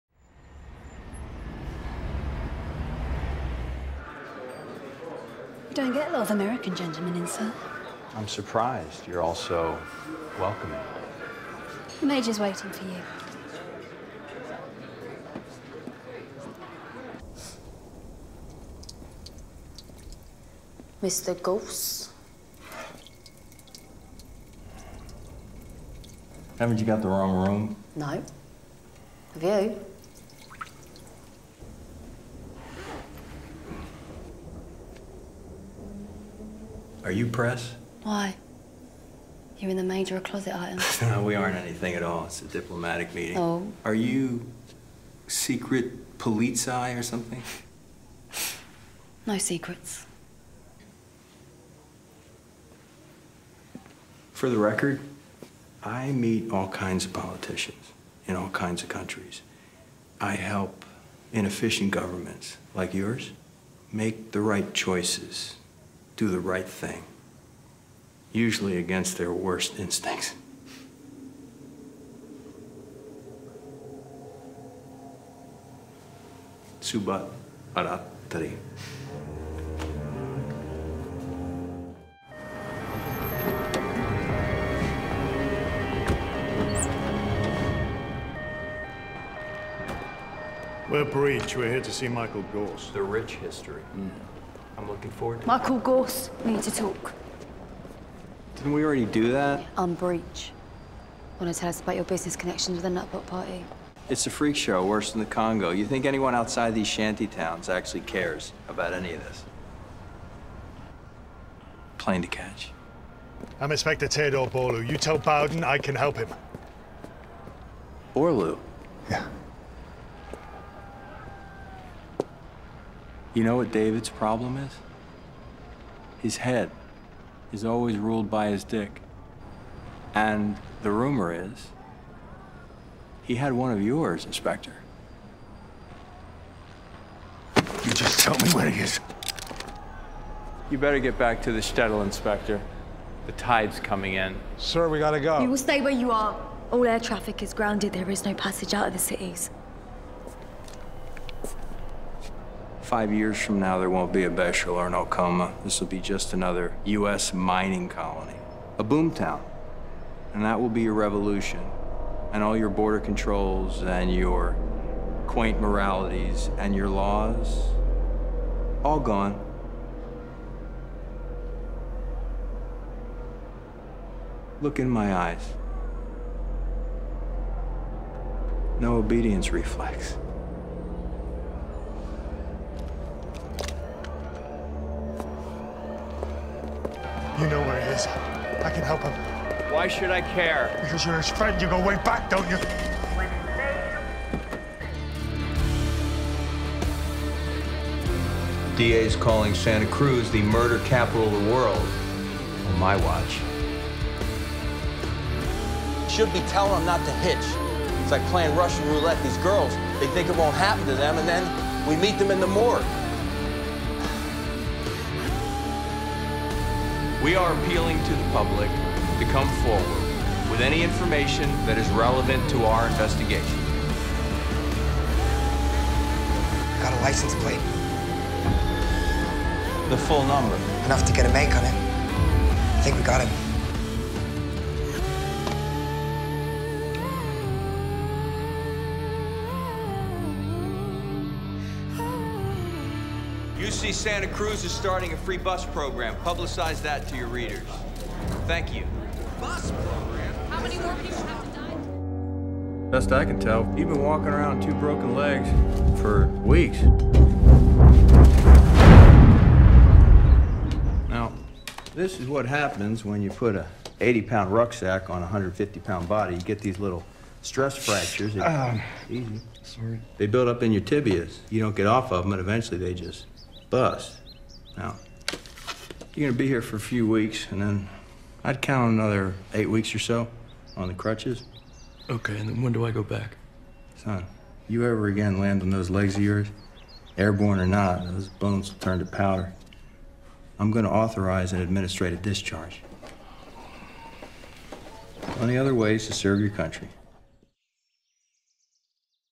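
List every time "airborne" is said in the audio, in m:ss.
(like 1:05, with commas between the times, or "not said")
4:47.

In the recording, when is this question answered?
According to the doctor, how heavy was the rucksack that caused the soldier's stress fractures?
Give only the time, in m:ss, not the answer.
4:24.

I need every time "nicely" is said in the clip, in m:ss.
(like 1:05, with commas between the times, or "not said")
not said.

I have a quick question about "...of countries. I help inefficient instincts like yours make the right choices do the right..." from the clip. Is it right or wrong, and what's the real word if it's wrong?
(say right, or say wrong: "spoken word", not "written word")
wrong: "governments", not "instincts".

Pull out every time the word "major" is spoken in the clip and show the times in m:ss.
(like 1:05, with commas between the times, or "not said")
0:12, 0:39.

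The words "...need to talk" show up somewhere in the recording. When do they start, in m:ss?
1:36.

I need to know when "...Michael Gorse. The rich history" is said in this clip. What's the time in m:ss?
1:32.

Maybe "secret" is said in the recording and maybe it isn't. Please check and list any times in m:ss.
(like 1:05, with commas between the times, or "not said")
0:45, 0:49.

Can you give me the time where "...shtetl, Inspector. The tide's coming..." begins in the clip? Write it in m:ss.
2:21.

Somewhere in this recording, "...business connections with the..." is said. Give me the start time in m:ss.
1:42.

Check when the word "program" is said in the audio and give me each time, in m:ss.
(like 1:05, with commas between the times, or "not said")
4:05, 4:09.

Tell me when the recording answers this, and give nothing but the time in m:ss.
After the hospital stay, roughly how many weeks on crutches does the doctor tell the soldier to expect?
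4:39.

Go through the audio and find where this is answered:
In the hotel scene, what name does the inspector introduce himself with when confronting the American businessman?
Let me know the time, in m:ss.
1:54.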